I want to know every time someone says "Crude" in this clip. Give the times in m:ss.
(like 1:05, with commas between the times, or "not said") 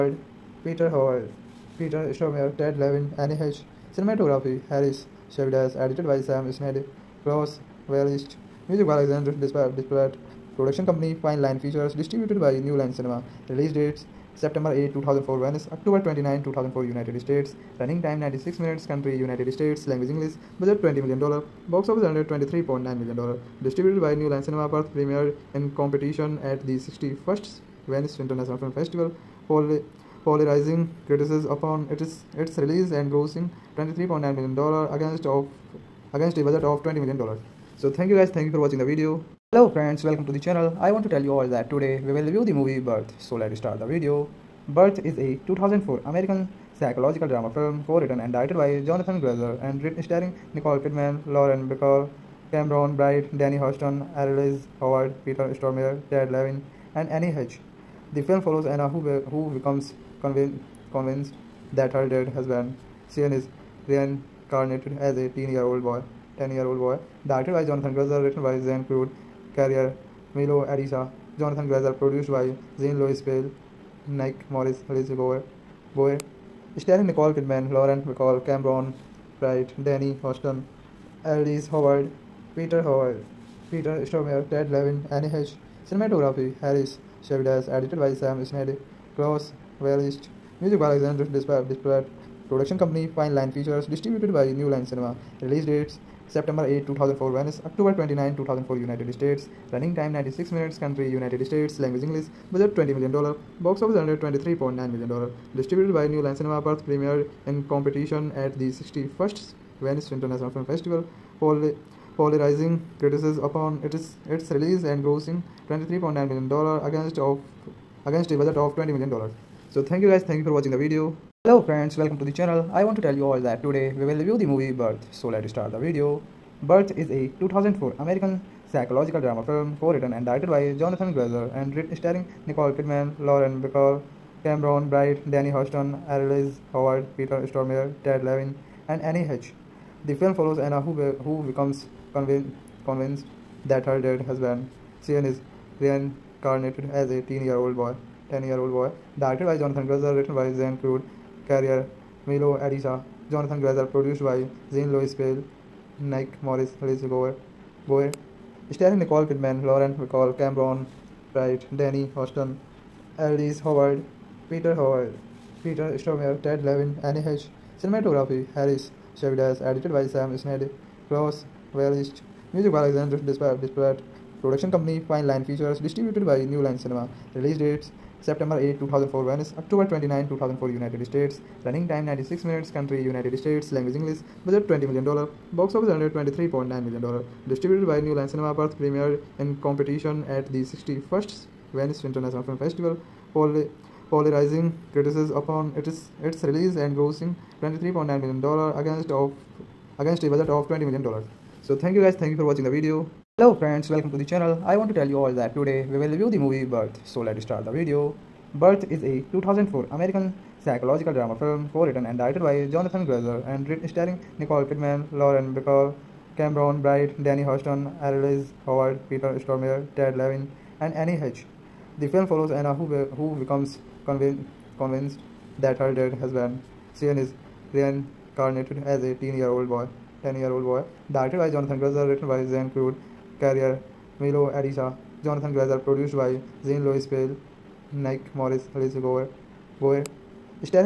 1:08, 2:30, 3:52.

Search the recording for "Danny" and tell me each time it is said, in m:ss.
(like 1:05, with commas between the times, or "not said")
0:53, 1:19, 2:15, 2:41, 3:37.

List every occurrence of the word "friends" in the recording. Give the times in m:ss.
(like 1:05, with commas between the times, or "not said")
0:39, 2:01, 3:23.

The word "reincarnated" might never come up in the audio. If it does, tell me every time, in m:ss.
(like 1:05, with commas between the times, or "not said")
1:03, 2:25, 3:47.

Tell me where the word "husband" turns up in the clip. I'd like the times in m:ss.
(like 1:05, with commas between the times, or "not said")
1:02, 2:24, 3:46.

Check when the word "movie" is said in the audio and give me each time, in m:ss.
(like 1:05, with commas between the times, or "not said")
0:42, 2:04, 3:26.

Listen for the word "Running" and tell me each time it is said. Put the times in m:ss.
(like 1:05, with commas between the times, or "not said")
0:17, 1:39, 3:01.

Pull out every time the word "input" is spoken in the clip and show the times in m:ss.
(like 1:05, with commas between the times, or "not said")
not said.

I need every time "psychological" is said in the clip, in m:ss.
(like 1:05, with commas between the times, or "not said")
0:46, 2:08, 3:30.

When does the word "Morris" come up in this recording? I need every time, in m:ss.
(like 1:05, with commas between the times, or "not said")
1:14, 2:36, 3:58.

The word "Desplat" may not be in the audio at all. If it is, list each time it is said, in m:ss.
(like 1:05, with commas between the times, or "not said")
0:09, 1:31, 2:53.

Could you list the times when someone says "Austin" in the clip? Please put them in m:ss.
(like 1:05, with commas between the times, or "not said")
1:20, 2:42.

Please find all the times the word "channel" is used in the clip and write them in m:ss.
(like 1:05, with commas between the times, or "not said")
0:40, 2:02, 3:24.